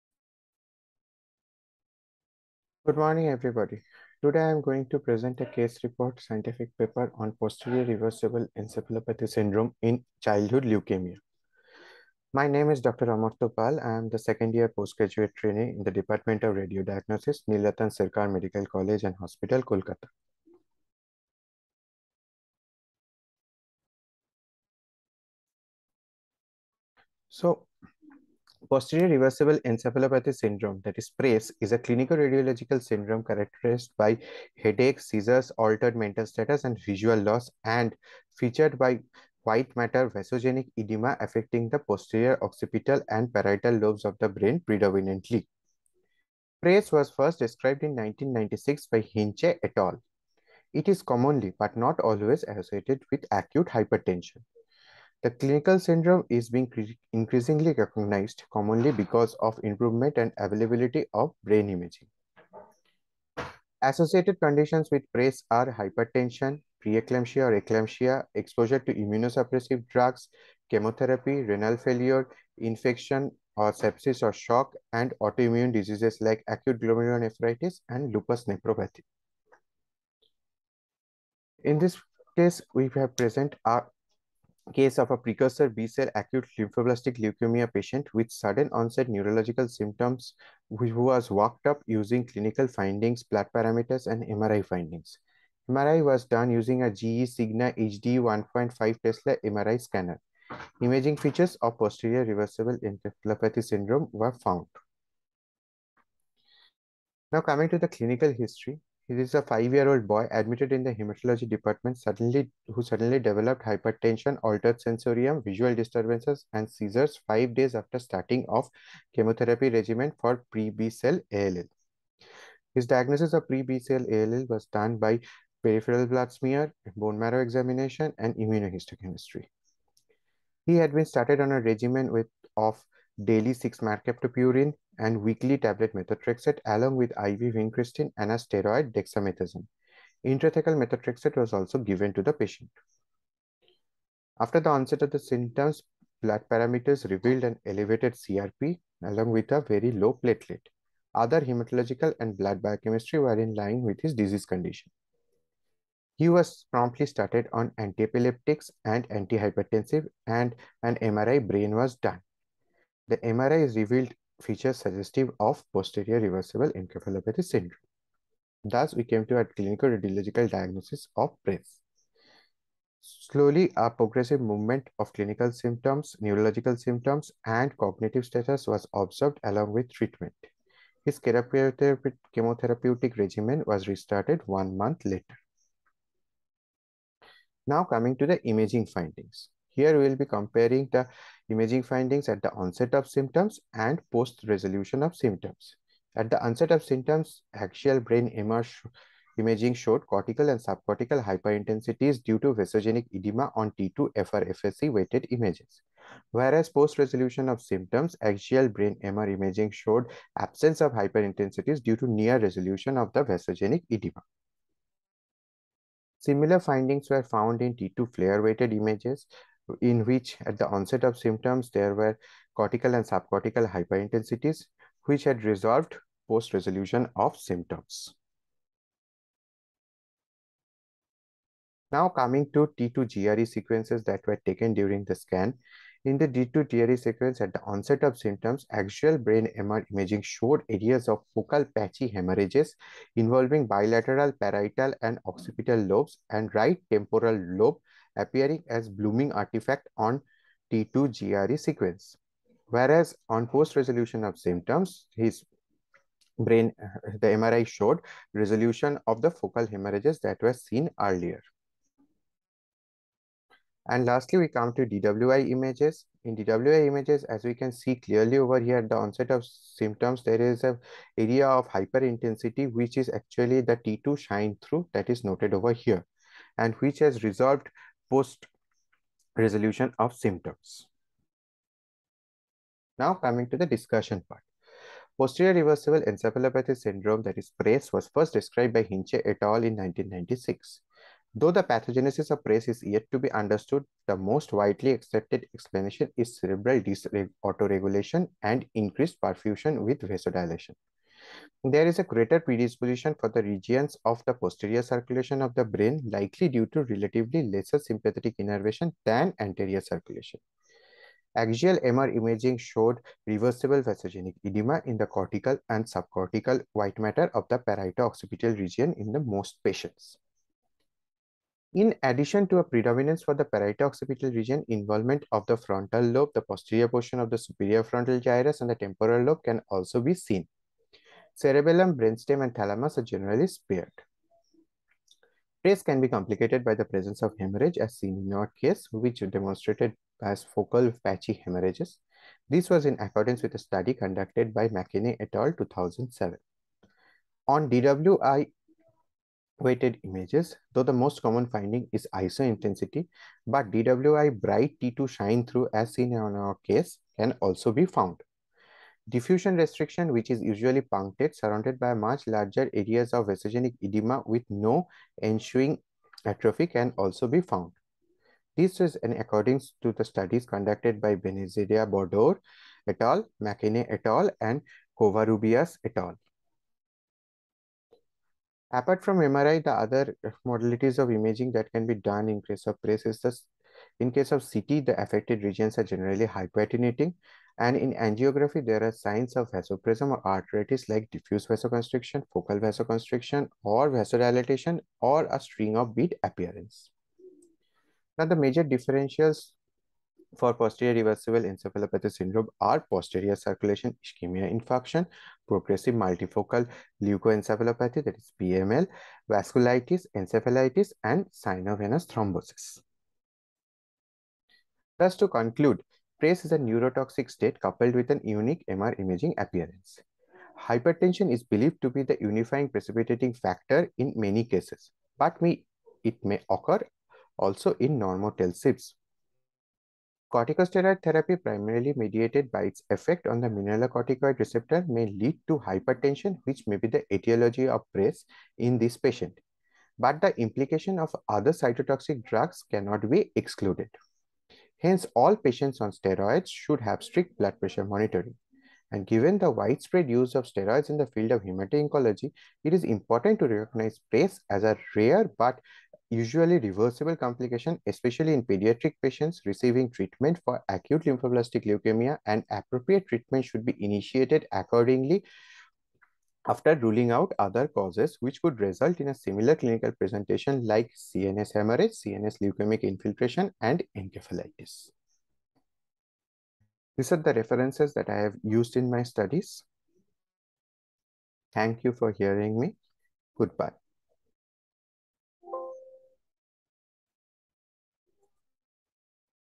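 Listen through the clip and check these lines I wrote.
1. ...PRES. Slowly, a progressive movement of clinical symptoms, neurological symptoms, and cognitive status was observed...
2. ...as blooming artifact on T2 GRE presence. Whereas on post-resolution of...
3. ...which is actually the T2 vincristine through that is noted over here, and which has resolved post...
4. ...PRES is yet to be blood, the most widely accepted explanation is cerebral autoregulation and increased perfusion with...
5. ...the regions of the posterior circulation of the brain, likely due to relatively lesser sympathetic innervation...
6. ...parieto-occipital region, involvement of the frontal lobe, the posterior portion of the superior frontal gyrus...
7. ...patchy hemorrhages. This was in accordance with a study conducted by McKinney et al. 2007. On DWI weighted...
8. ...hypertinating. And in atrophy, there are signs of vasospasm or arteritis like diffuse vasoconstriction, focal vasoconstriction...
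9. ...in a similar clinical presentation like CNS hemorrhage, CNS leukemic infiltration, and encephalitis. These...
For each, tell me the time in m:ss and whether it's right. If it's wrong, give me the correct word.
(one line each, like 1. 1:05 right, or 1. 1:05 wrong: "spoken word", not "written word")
1. 2:51 right
2. 4:08 wrong: "sequence", not "presence"
3. 4:32 wrong: "shine", not "vincristine"
4. 4:52 wrong: "understood", not "blood"
5. 5:03 right
6. 5:23 right
7. 5:41 right
8. 6:26 wrong: "angiography", not "atrophy"
9. 7:48 right.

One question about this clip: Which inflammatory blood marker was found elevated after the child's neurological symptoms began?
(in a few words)
CRP.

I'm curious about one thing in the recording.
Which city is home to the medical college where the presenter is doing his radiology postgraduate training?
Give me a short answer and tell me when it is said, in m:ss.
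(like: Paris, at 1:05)
Kolkata, at 0:19.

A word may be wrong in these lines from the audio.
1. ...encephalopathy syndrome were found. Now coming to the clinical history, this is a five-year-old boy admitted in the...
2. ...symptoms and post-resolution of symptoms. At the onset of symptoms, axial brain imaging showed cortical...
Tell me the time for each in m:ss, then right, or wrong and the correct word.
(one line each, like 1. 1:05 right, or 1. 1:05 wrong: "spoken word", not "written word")
1. 1:42 right
2. 3:13 right.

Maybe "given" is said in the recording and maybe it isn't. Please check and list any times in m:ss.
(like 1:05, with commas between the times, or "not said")
2:21, 7:29.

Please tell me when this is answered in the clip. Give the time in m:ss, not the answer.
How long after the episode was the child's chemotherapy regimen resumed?
3:04.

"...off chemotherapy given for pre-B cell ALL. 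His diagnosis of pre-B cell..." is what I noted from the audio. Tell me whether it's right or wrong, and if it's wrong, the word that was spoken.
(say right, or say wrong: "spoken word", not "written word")
wrong: "regimen", not "given".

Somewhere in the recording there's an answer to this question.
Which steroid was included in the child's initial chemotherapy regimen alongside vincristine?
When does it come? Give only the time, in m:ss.
2:18.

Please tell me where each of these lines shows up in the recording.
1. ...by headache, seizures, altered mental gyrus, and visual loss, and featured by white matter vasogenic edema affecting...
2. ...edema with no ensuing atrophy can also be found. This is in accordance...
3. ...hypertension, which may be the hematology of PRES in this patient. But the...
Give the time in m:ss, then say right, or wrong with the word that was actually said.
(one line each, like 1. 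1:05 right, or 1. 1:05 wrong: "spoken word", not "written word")
1. 0:33 wrong: "status", not "gyrus"
2. 6:03 right
3. 7:15 wrong: "etiology", not "hematology".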